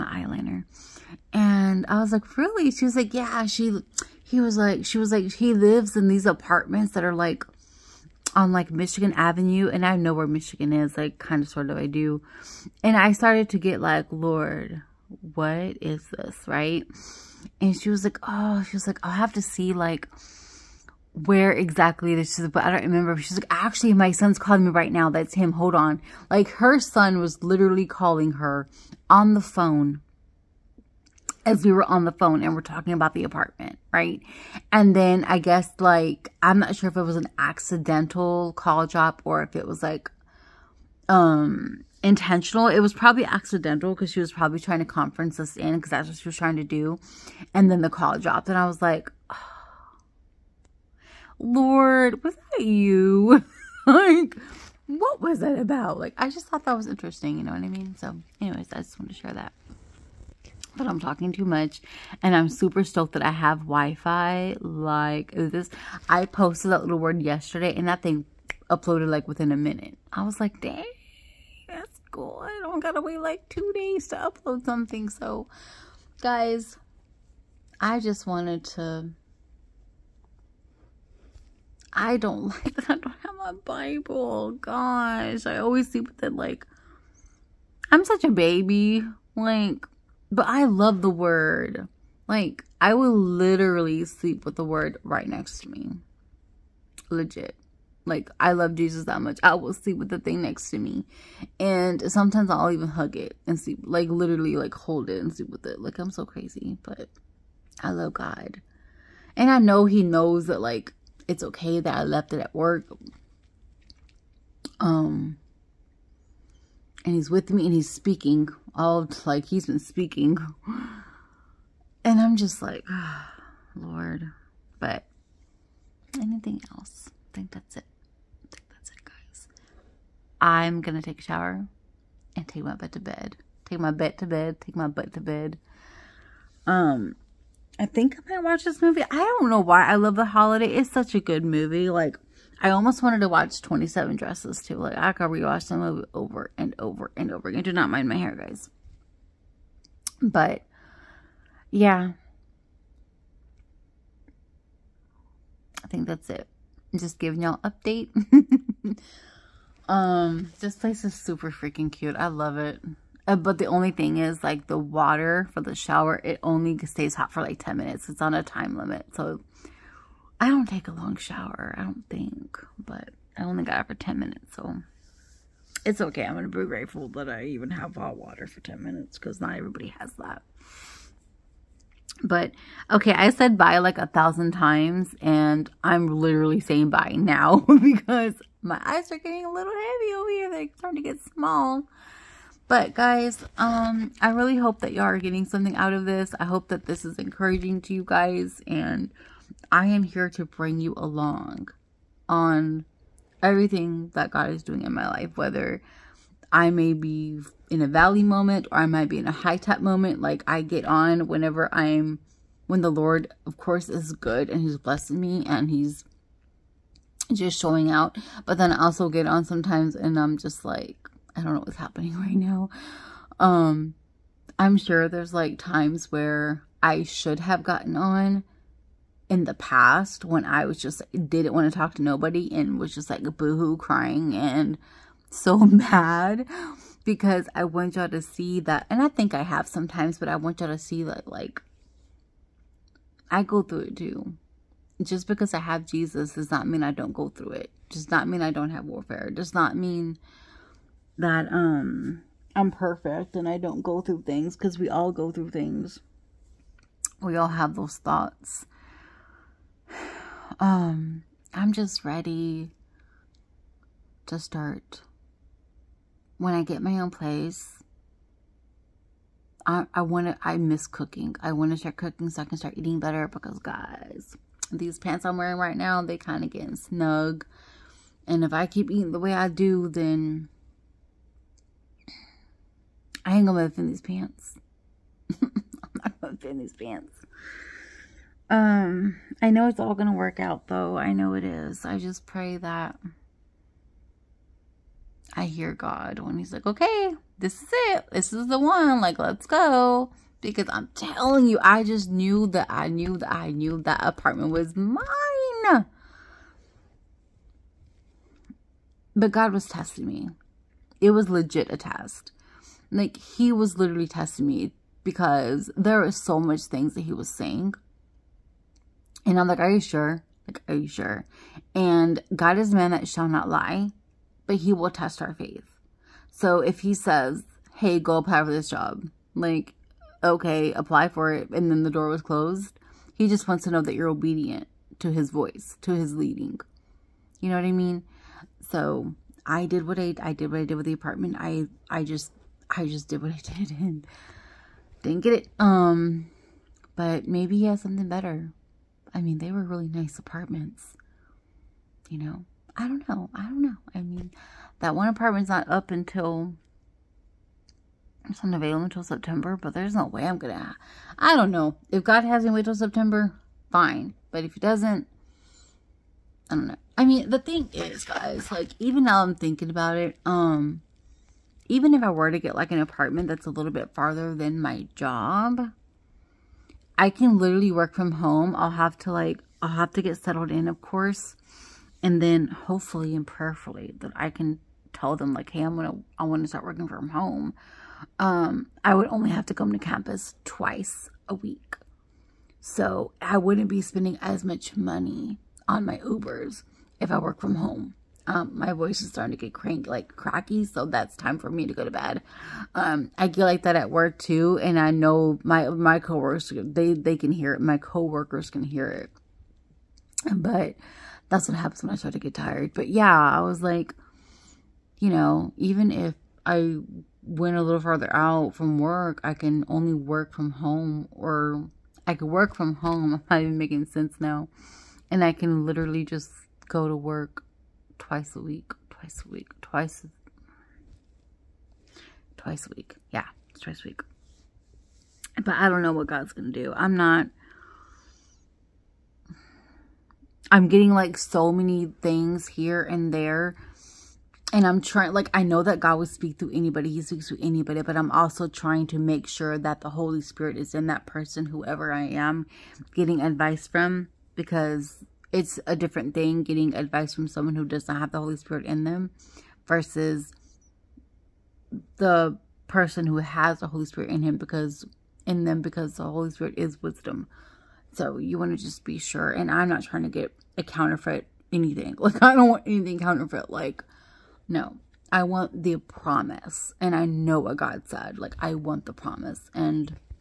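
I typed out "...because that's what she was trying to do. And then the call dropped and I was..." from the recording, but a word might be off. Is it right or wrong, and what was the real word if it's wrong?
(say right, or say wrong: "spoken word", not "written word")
right.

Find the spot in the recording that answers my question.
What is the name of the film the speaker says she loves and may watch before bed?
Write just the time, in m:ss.
2:20.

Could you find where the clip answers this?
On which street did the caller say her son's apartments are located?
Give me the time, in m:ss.
0:08.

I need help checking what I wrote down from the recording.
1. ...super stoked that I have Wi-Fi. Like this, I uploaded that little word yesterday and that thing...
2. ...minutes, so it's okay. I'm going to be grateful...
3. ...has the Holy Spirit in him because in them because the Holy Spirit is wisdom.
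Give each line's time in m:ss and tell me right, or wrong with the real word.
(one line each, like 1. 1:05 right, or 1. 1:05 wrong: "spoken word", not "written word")
1. 1:02 wrong: "posted", not "uploaded"
2. 2:54 right
3. 7:43 right.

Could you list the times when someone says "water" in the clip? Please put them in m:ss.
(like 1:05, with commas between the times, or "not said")
2:44, 2:58.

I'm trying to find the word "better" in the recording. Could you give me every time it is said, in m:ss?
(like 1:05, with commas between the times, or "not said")
4:32, 5:48.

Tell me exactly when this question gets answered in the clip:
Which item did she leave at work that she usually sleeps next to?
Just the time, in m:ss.
1:23.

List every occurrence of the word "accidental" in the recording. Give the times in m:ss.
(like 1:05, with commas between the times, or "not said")
0:37, 0:43.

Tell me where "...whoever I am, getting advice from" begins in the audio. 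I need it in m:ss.
7:31.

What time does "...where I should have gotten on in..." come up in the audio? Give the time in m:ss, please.
3:46.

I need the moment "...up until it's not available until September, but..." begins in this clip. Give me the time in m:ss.
5:55.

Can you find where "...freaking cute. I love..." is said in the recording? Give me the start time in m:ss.
2:41.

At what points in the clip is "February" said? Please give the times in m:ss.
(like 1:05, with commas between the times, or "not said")
not said.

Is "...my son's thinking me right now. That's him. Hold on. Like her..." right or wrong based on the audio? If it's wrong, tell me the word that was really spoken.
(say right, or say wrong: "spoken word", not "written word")
wrong: "calling", not "thinking".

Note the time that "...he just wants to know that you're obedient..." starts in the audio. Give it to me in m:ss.
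5:33.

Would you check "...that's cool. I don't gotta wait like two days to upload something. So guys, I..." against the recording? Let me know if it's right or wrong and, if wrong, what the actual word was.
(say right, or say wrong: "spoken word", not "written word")
right.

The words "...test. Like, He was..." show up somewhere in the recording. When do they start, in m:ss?
5:11.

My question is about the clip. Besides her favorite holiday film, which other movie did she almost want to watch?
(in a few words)
27 Dresses.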